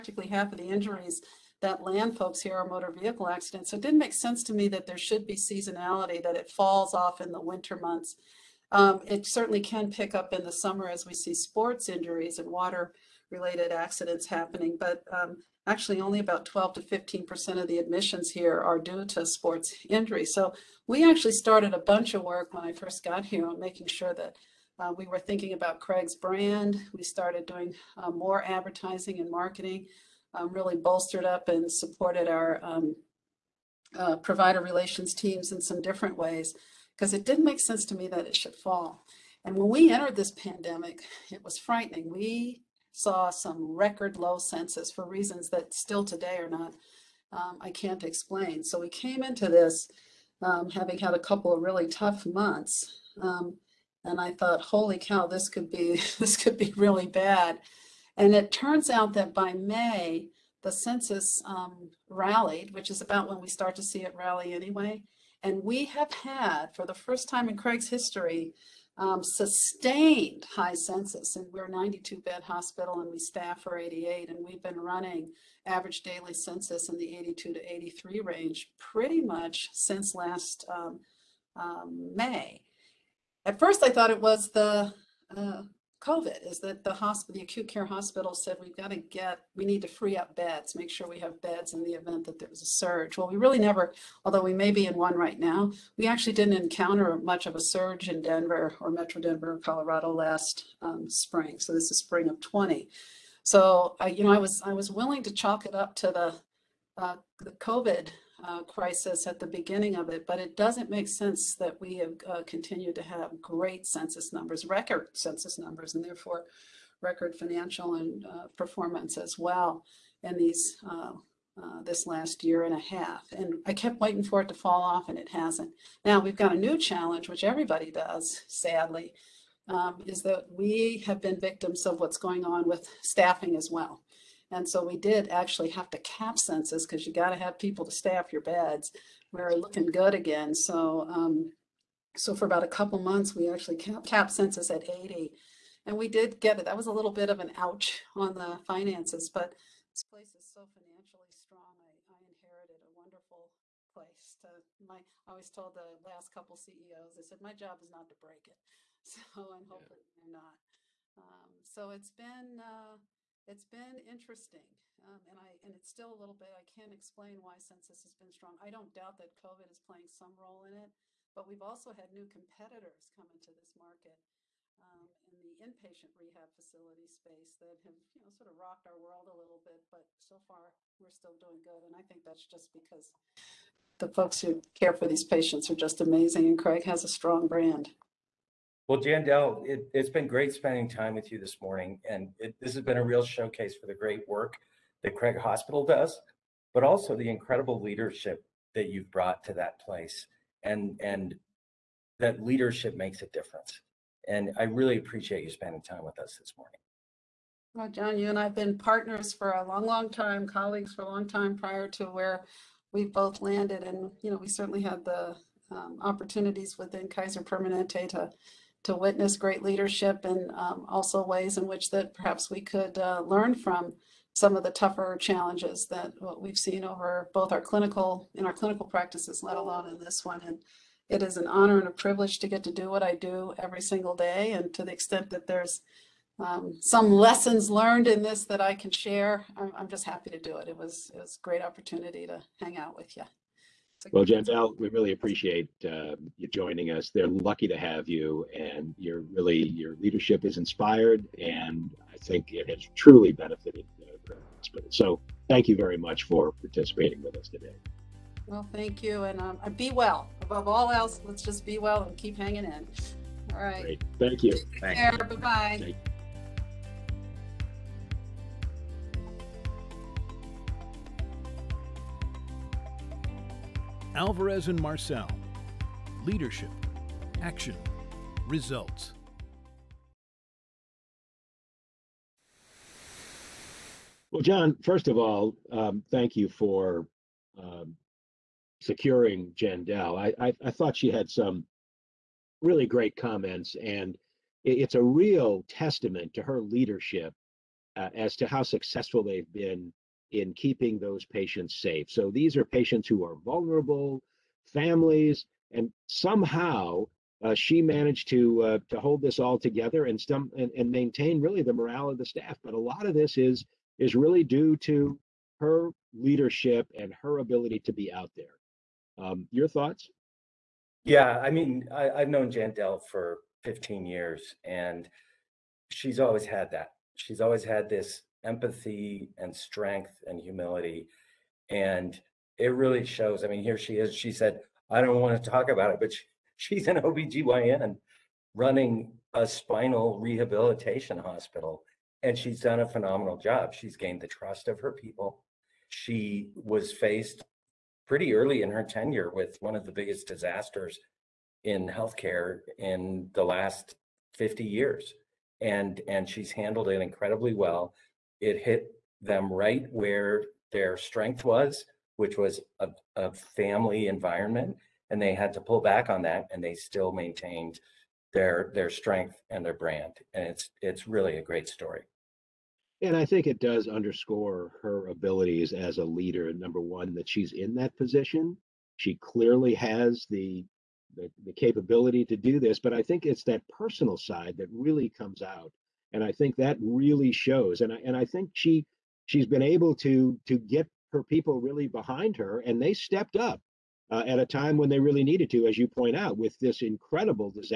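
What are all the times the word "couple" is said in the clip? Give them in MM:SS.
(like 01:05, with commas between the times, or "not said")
00:51, 02:22, 02:36.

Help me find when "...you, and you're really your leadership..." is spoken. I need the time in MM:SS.
04:08.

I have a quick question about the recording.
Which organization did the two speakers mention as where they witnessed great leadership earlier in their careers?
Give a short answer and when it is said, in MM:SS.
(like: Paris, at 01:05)
Kaiser Permanente, at 03:37.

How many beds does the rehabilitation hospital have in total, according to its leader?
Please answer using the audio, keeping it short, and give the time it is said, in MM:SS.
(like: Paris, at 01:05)
92, at 01:11.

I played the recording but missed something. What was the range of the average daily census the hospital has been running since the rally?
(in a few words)
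82 to 83.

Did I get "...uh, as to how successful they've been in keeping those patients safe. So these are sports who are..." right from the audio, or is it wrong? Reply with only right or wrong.
wrong.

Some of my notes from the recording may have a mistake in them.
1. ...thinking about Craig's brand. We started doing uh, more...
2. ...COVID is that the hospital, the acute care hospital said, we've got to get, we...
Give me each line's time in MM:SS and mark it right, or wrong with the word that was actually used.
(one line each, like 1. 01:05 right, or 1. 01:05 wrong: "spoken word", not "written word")
1. 00:25 right
2. 01:26 right.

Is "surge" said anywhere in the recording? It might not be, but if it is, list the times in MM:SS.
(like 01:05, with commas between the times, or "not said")
01:32, 01:37.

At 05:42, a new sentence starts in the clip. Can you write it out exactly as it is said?
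And she's done a phenomenal job.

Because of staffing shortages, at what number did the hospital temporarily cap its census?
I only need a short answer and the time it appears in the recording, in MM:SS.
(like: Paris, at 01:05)
80, at 02:24.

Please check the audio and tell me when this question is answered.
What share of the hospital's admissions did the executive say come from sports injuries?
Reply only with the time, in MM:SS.
00:16.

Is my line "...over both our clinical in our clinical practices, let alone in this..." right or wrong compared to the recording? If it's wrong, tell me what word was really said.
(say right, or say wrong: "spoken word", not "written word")
right.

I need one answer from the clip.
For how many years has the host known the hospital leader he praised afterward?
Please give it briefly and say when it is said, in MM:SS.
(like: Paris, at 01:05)
15 years, at 05:23.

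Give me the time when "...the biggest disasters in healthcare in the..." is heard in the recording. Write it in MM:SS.
05:49.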